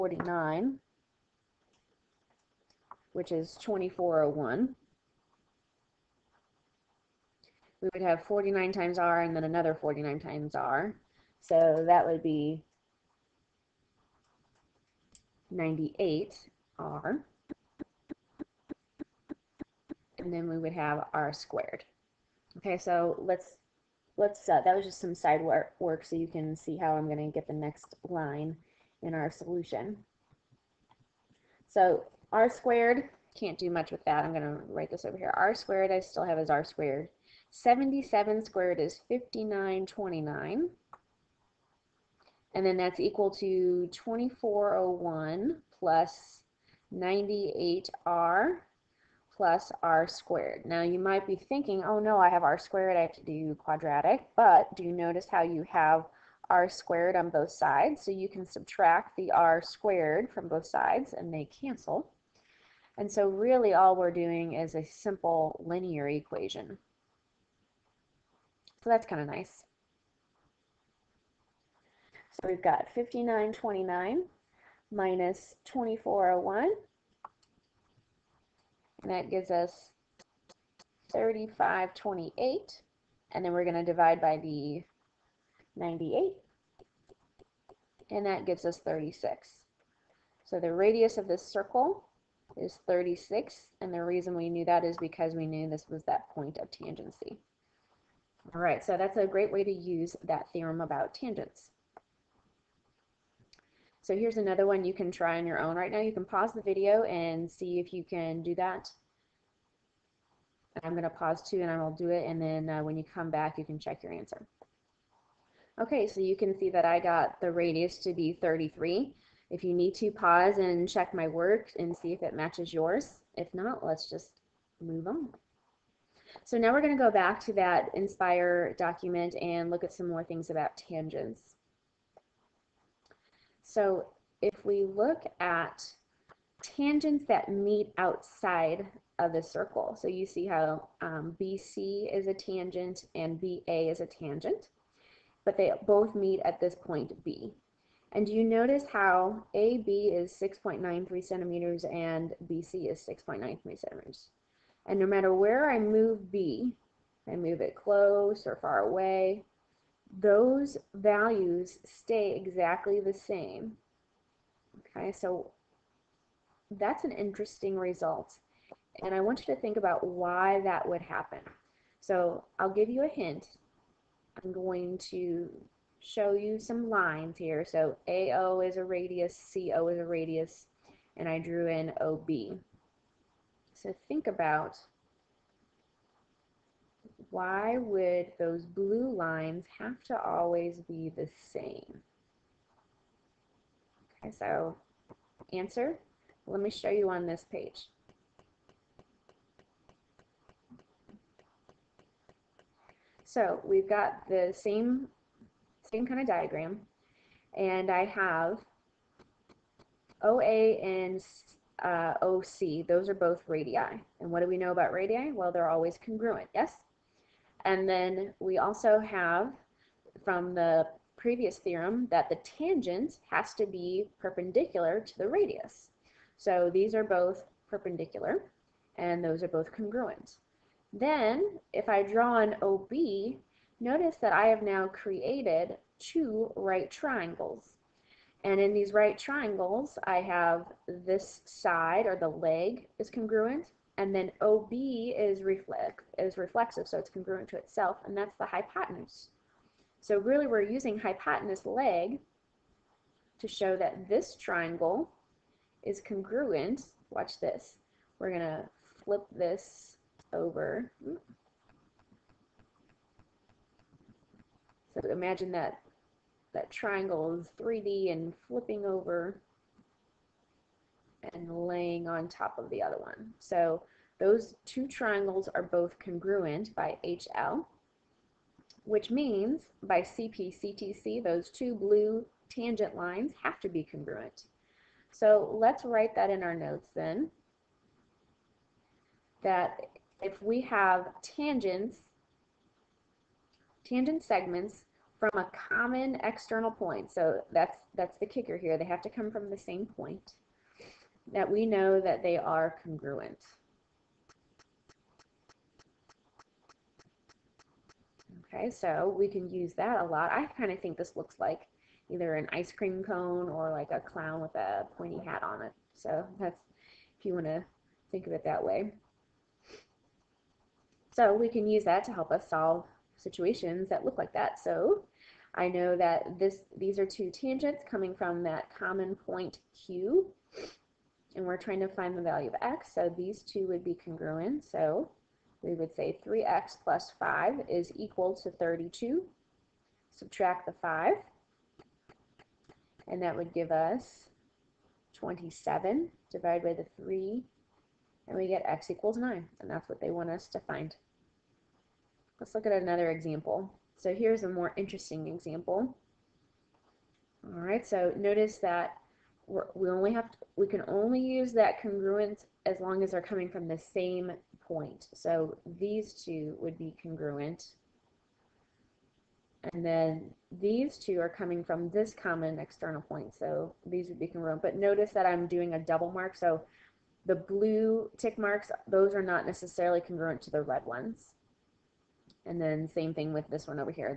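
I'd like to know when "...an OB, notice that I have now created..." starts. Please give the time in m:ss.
3:52.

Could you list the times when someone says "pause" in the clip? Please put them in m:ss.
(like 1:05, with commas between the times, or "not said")
1:46, 1:51, 2:00.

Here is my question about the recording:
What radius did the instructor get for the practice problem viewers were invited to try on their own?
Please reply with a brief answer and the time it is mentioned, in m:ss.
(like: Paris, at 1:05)
33, at 1:58.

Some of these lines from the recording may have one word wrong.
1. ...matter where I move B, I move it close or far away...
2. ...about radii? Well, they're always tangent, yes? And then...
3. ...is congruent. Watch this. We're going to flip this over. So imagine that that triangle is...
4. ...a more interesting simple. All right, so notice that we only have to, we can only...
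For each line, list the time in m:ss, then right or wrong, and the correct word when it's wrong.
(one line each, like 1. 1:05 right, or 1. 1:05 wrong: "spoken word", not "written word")
1. 2:35 right
2. 3:34 wrong: "congruent", not "tangent"
3. 4:15 right
4. 5:54 wrong: "example", not "simple".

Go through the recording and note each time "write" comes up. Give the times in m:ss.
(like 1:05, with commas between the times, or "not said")
0:34, 4:45.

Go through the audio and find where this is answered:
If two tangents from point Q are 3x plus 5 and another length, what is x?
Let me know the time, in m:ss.
5:48.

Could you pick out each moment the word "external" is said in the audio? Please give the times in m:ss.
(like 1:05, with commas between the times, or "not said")
4:56, 6:12.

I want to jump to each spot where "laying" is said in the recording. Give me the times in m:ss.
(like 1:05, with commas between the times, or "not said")
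4:31.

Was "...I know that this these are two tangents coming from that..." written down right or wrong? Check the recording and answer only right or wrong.
right.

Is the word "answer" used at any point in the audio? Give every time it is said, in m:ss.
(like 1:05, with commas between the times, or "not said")
1:54, 3:15.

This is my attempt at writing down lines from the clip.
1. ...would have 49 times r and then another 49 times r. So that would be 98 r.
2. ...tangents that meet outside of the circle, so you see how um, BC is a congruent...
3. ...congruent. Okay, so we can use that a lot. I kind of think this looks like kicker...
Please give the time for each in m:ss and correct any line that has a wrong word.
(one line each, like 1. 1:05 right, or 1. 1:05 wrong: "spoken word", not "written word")
1. 0:07 right
2. 2:16 wrong: "tangent", not "congruent"
3. 5:02 wrong: "either", not "kicker".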